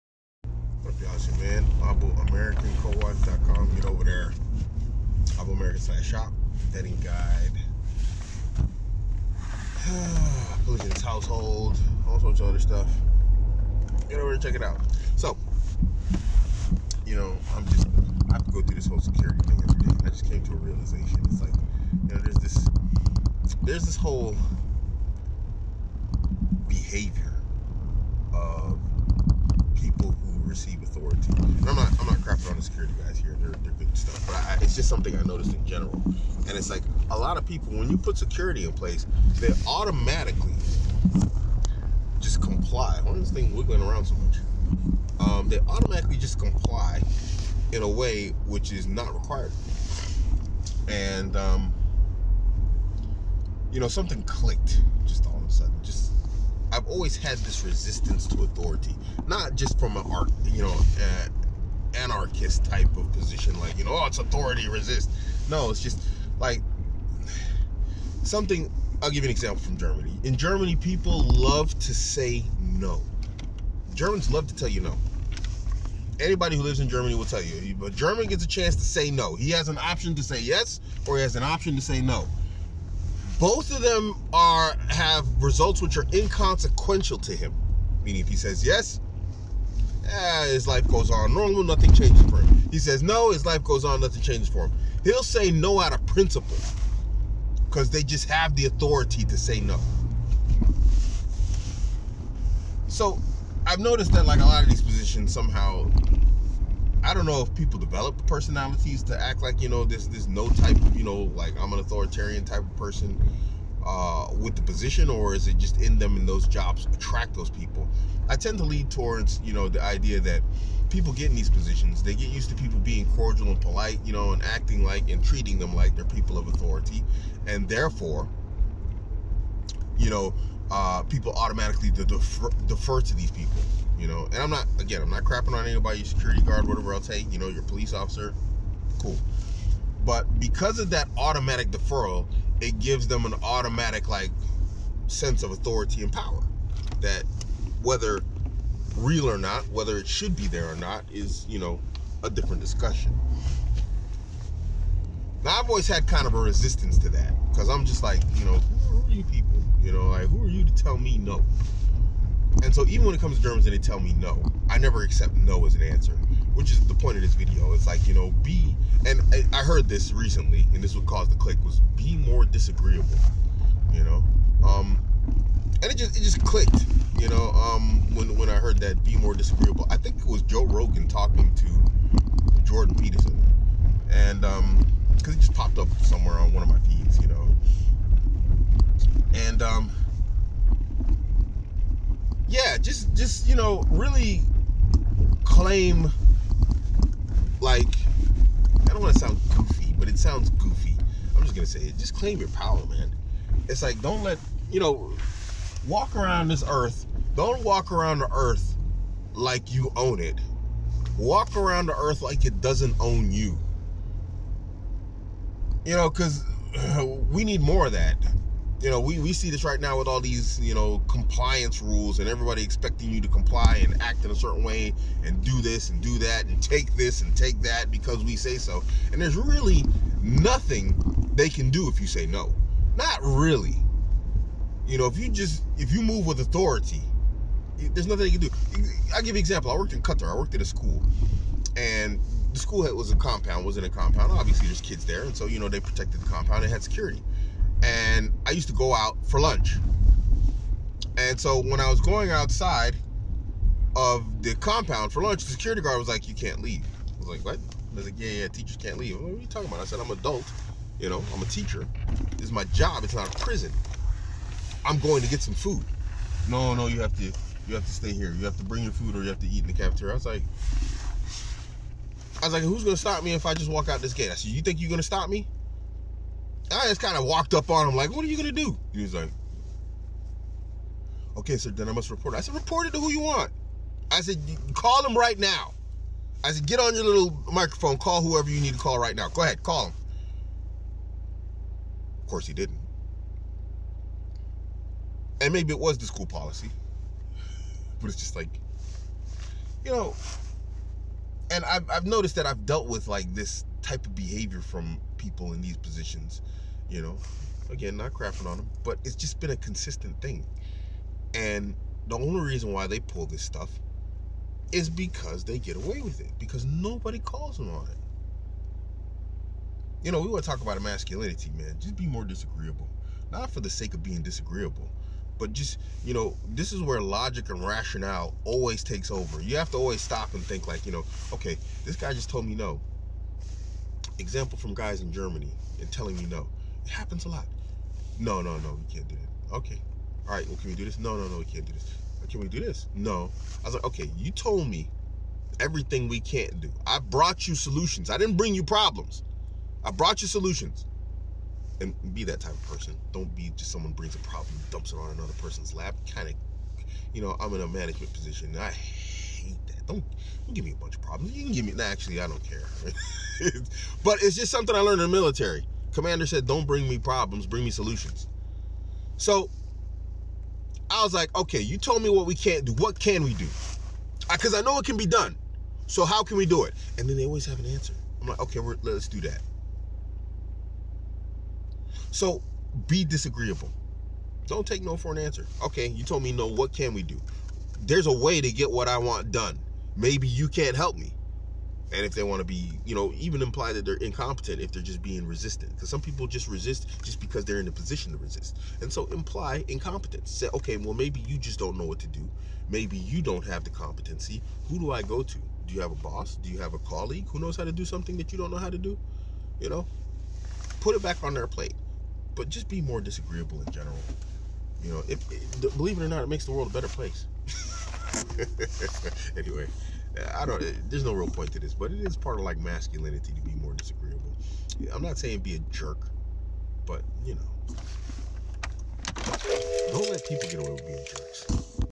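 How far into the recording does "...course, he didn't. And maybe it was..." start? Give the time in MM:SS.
04:52.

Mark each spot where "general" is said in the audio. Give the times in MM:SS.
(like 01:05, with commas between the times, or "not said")
00:35, 06:53.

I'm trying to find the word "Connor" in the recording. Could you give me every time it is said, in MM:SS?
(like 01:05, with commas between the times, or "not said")
not said.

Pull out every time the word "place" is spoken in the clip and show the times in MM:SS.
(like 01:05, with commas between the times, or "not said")
00:38, 06:56.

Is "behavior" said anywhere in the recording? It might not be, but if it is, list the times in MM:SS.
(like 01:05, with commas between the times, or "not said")
00:26, 05:04.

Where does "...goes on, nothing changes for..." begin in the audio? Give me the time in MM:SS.
01:33.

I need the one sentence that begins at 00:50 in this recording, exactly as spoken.
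And um, you know something clicked just all of a sudden.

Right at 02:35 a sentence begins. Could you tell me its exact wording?
Now I've always had kind of a resistance to that because I'm just like you know who are you people?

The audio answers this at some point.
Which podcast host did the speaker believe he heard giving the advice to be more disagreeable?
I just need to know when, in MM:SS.
03:00.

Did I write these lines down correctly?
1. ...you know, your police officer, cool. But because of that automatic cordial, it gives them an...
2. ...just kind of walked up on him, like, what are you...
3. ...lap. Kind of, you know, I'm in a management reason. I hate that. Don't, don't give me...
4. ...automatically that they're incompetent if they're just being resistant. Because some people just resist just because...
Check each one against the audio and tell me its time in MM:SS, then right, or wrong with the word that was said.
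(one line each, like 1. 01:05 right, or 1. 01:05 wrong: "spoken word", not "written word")
1. 02:17 wrong: "deferral", not "cordial"
2. 04:36 right
3. 05:55 wrong: "position", not "reason"
4. 06:33 wrong: "imply", not "automatically".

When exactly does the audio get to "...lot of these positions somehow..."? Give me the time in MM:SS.
01:44.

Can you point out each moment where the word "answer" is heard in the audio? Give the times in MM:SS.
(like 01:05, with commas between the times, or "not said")
02:45, 06:17, 06:25.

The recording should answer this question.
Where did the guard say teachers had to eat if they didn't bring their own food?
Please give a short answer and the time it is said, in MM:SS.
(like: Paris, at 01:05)
the cafeteria, at 04:29.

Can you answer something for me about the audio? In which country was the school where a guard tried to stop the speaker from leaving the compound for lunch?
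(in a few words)
Qatar.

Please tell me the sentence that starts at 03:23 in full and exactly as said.
It's like don't let you know walk around this earth.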